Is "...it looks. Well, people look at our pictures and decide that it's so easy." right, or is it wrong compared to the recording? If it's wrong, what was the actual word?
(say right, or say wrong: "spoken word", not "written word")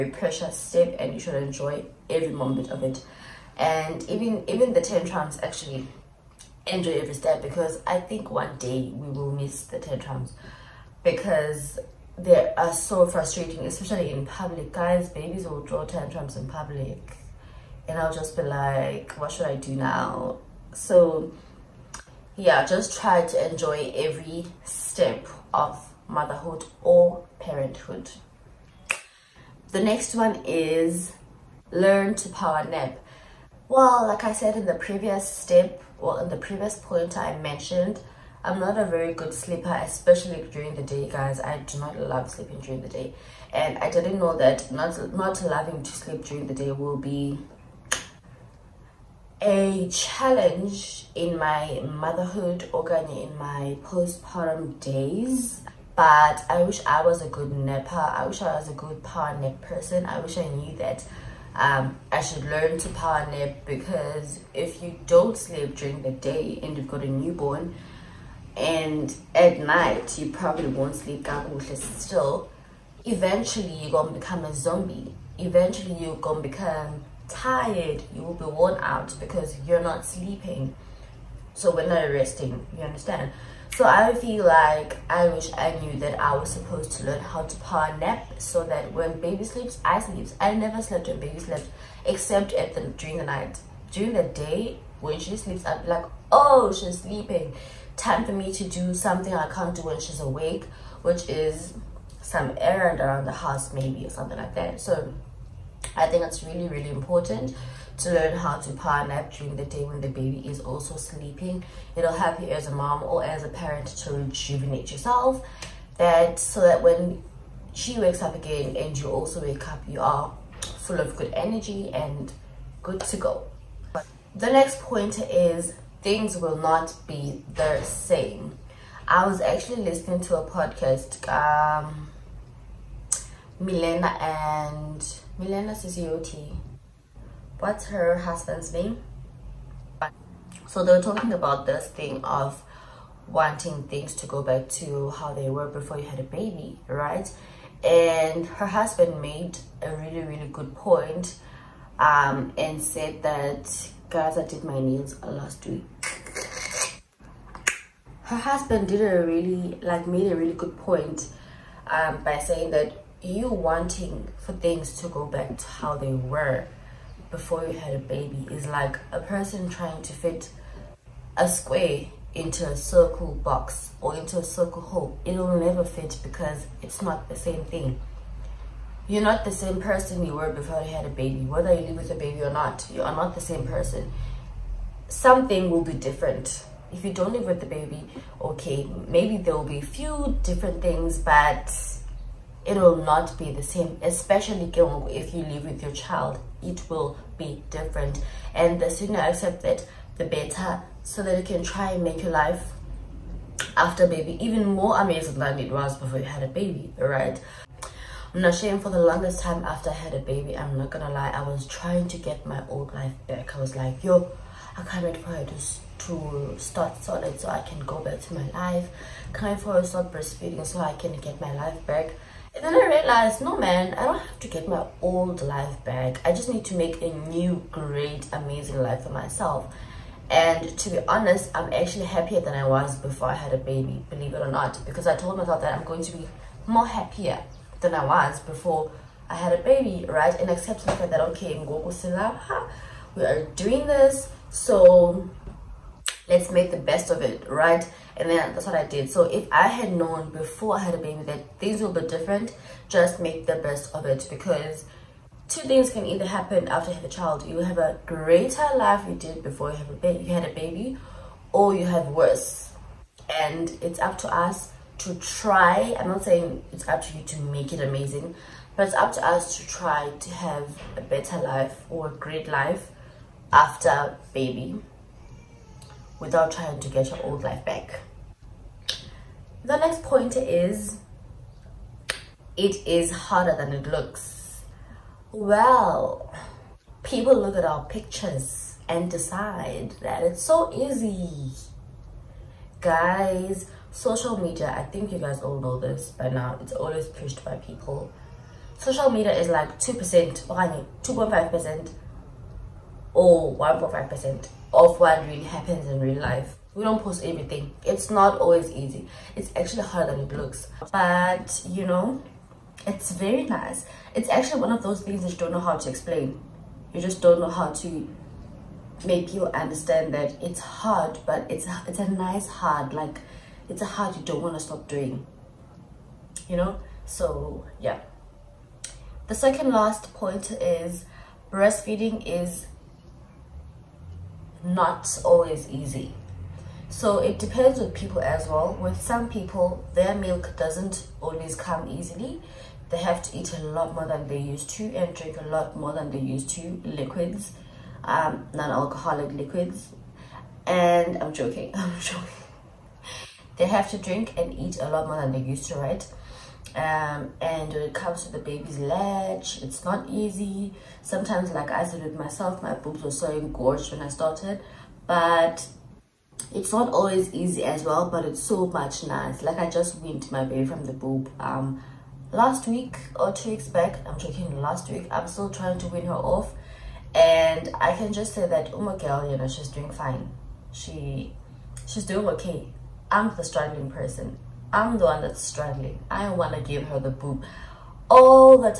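right.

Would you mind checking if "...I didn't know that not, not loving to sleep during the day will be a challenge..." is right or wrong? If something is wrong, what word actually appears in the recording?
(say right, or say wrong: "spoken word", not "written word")
right.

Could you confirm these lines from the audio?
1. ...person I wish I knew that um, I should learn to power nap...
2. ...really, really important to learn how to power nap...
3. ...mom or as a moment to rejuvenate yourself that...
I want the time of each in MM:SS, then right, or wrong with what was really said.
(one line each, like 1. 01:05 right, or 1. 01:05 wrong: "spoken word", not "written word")
1. 00:59 right
2. 01:46 right
3. 01:52 wrong: "parent", not "moment".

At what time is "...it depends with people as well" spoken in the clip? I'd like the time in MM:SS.
05:37.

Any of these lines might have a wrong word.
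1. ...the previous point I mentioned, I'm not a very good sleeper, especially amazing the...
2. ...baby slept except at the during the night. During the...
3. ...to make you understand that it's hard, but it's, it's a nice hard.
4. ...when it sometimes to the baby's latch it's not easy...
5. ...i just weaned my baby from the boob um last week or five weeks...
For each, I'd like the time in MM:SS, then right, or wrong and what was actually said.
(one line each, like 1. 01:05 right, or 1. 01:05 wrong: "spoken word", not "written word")
1. 00:36 wrong: "during", not "amazing"
2. 01:31 right
3. 05:17 right
4. 05:57 wrong: "comes", not "sometimes"
5. 06:09 wrong: "two", not "five".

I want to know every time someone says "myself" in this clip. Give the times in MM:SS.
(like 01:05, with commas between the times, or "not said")
03:49, 03:55, 06:02.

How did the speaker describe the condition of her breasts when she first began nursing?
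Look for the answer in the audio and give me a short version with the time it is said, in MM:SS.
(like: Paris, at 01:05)
engorged, at 06:03.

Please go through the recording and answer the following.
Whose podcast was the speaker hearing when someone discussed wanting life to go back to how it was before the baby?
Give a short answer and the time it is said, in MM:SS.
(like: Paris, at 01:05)
Milena Suzuki, at 02:15.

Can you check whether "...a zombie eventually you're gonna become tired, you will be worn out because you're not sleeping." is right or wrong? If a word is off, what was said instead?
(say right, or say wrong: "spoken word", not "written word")
right.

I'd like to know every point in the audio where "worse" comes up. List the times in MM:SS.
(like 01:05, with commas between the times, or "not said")
04:22.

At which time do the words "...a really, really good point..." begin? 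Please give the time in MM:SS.
02:29.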